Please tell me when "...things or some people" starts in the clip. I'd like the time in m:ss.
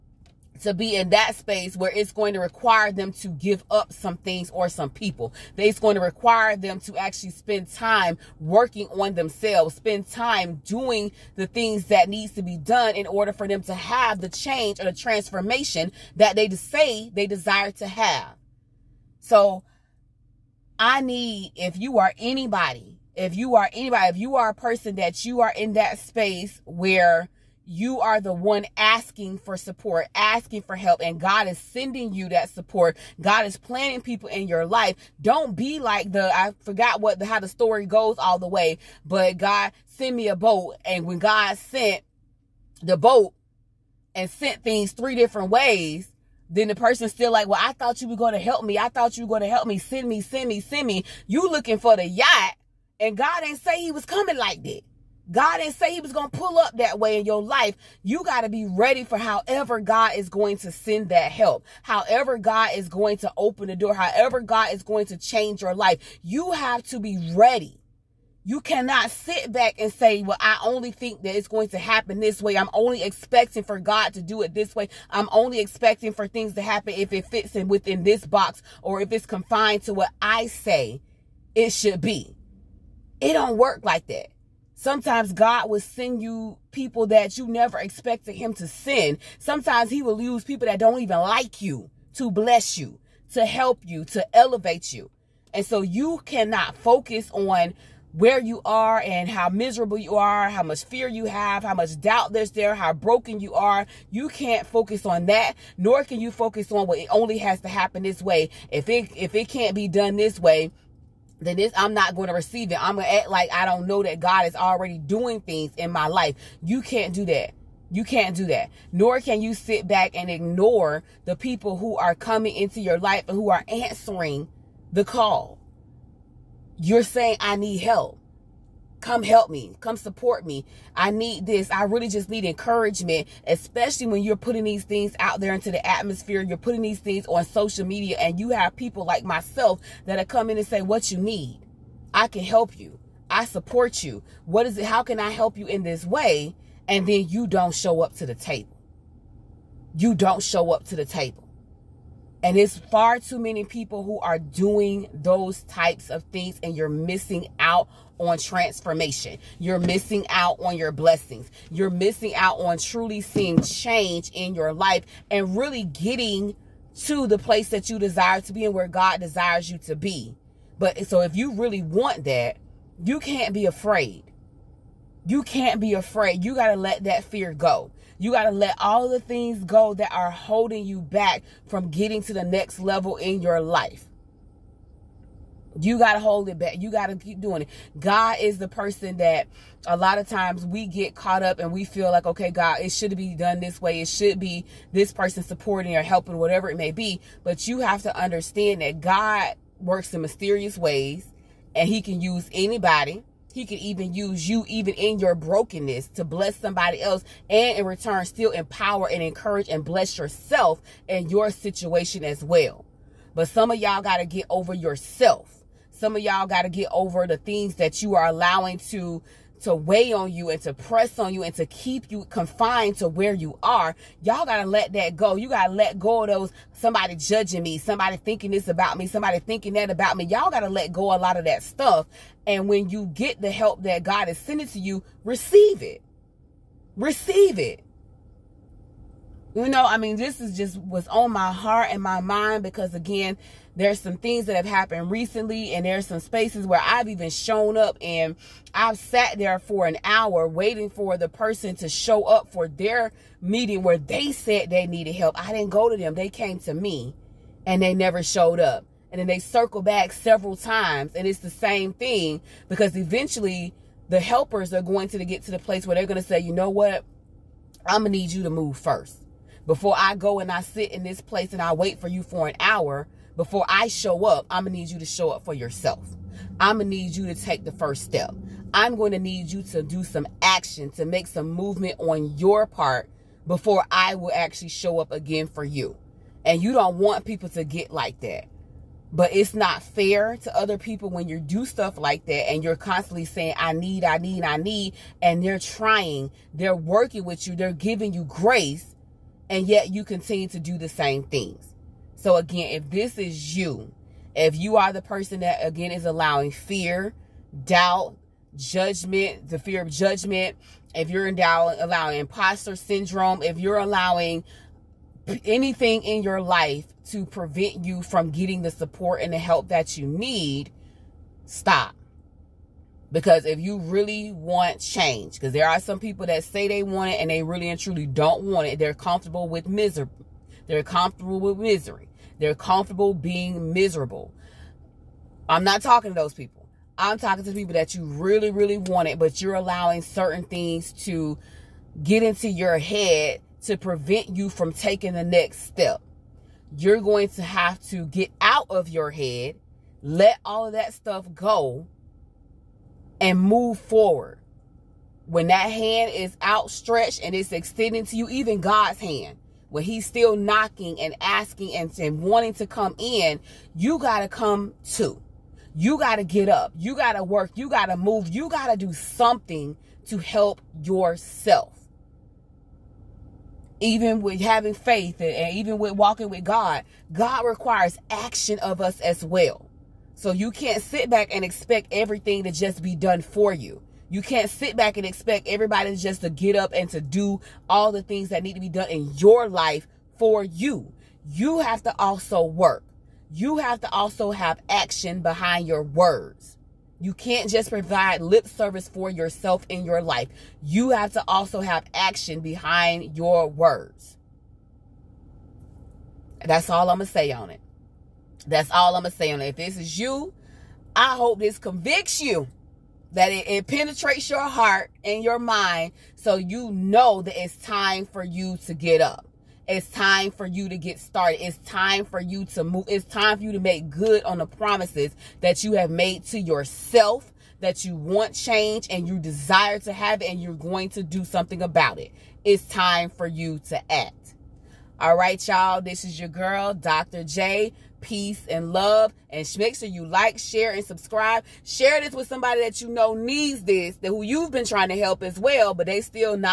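0:04.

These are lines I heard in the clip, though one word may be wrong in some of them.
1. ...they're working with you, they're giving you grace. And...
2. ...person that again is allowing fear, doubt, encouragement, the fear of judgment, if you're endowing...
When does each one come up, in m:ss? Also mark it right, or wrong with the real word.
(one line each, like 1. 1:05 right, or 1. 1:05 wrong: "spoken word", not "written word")
1. 4:56 right
2. 5:05 wrong: "judgment", not "encouragement".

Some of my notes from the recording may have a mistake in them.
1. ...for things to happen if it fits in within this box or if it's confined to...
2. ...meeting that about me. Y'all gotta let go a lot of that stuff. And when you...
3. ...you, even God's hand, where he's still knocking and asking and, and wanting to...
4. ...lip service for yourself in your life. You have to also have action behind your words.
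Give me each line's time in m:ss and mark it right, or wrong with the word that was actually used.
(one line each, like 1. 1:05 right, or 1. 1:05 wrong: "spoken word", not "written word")
1. 1:16 right
2. 3:49 wrong: "thinking", not "meeting"
3. 5:58 right
4. 6:38 right.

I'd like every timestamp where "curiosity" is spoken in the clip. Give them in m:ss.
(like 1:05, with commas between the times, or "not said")
not said.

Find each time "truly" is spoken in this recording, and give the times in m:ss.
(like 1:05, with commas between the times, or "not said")
2:42, 5:27.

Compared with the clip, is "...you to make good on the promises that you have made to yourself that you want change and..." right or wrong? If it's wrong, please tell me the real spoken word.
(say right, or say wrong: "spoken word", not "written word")
right.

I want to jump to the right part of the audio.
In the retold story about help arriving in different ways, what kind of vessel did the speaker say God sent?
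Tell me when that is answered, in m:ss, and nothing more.
0:39.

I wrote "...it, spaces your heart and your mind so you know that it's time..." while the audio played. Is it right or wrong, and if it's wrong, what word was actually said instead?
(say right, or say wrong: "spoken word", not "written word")
wrong: "penetrates", not "spaces".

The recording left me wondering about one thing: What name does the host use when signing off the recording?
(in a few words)
Dr. J.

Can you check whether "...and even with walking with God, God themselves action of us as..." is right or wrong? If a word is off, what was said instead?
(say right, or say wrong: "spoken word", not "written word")
wrong: "requires", not "themselves".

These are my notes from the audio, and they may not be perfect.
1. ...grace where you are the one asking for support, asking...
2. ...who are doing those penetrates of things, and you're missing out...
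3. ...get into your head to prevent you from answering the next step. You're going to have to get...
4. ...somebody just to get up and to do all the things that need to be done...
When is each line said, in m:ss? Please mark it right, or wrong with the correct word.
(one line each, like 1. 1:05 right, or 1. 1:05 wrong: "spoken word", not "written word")
1. 0:25 wrong: "space", not "grace"
2. 2:34 wrong: "types", not "penetrates"
3. 5:42 wrong: "taking", not "answering"
4. 6:25 wrong: "everybody", not "somebody".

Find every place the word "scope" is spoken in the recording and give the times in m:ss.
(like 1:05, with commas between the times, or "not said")
not said.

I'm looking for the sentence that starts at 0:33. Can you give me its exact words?
God is planting people in your life.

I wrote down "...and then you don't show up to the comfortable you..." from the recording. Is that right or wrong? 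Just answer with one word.
wrong.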